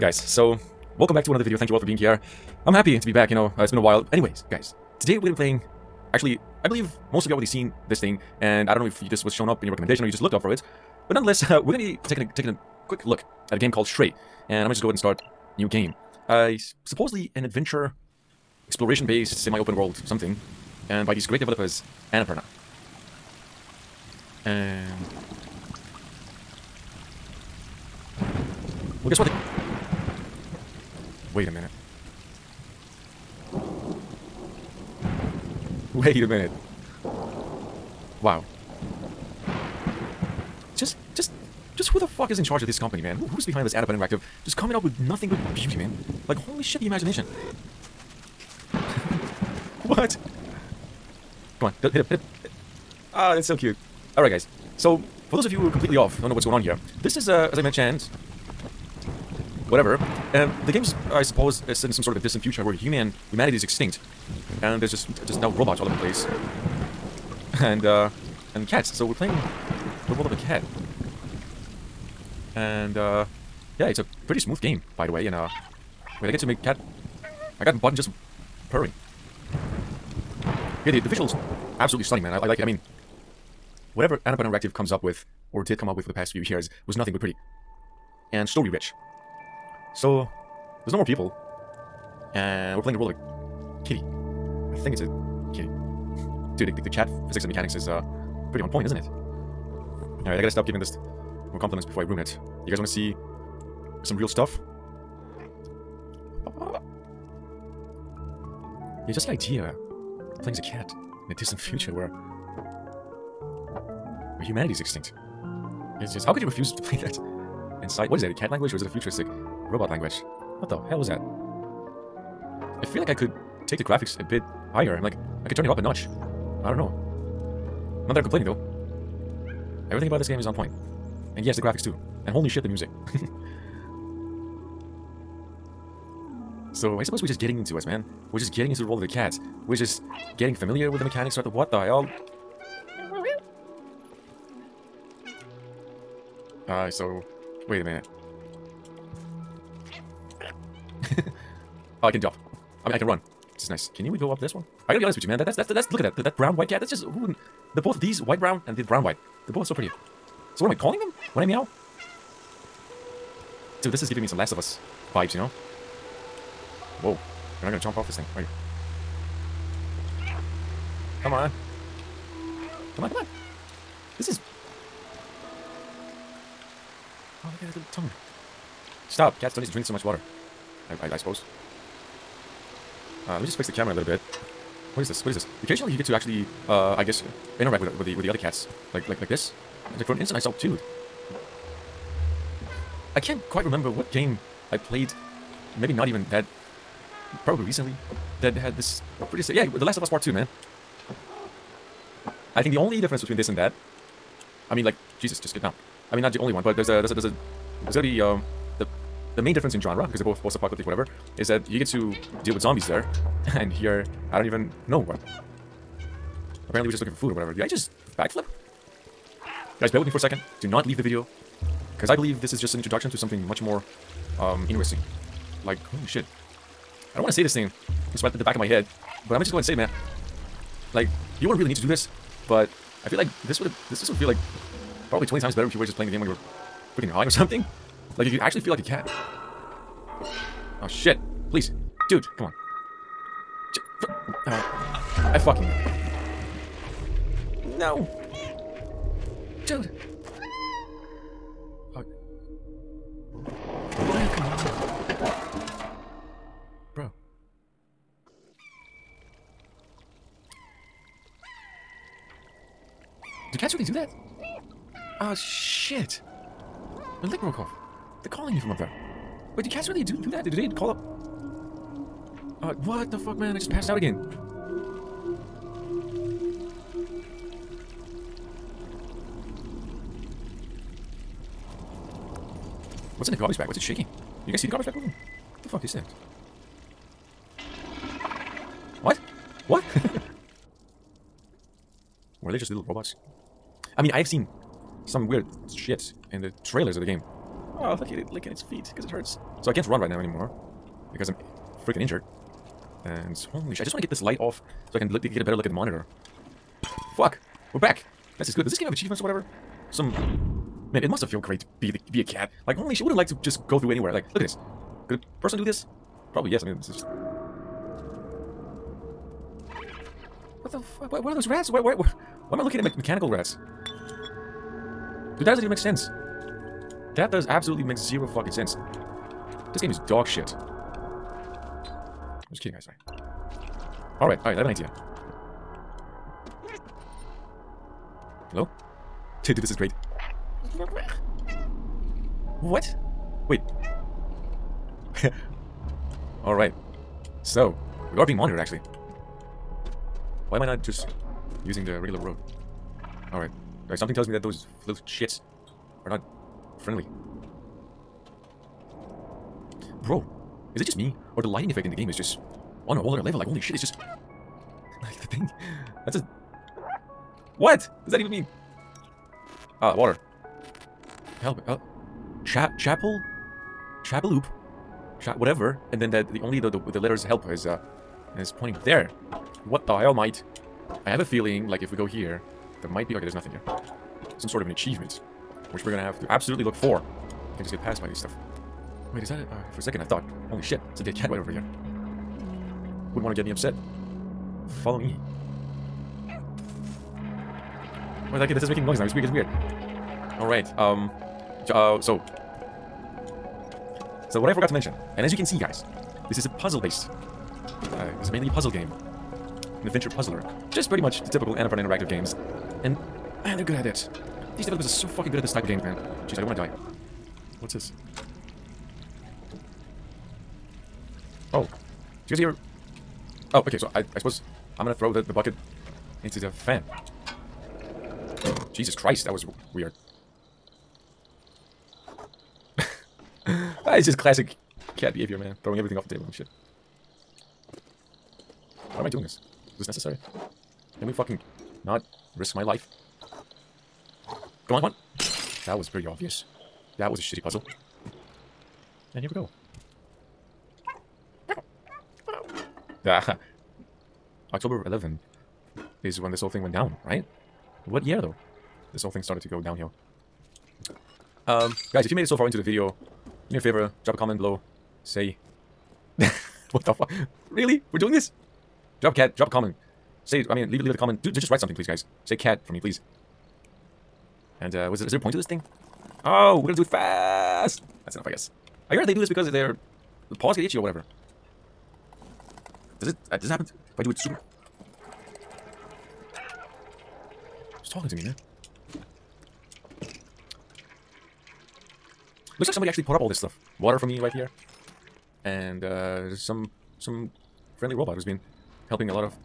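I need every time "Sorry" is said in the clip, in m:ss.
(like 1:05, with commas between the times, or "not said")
5:32.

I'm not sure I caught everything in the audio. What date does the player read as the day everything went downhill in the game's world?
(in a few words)
October 11.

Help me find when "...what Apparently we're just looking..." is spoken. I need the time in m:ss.
3:35.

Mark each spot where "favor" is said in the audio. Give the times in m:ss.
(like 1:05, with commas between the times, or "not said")
7:43.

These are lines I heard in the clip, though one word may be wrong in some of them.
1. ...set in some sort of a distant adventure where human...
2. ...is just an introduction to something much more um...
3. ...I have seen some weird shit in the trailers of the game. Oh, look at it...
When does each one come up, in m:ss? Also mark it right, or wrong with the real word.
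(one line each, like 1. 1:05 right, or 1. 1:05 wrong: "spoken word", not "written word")
1. 1:01 wrong: "future", not "adventure"
2. 3:42 right
3. 4:54 right.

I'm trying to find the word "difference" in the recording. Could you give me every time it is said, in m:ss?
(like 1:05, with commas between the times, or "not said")
3:23, 3:29.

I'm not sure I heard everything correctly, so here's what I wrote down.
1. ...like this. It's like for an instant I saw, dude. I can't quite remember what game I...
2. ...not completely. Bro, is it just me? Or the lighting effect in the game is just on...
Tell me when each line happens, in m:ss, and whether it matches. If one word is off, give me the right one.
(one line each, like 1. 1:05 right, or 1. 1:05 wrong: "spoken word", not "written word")
1. 3:09 right
2. 5:56 wrong: "friendly", not "completely".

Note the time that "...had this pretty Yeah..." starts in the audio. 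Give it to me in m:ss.
3:18.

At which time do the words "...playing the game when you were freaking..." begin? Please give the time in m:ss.
3:55.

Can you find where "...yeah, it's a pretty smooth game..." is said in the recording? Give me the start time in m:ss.
1:13.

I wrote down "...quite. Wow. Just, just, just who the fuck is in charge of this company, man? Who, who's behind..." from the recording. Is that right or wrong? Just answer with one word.
wrong.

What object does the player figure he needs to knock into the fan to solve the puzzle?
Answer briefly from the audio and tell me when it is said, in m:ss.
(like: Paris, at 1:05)
The bucket, at 7:05.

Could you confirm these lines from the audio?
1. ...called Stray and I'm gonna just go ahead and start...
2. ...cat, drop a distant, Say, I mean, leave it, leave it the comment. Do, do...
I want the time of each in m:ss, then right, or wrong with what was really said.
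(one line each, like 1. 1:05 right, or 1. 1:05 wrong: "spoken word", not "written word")
1. 0:13 right
2. 7:49 wrong: "comment", not "distant".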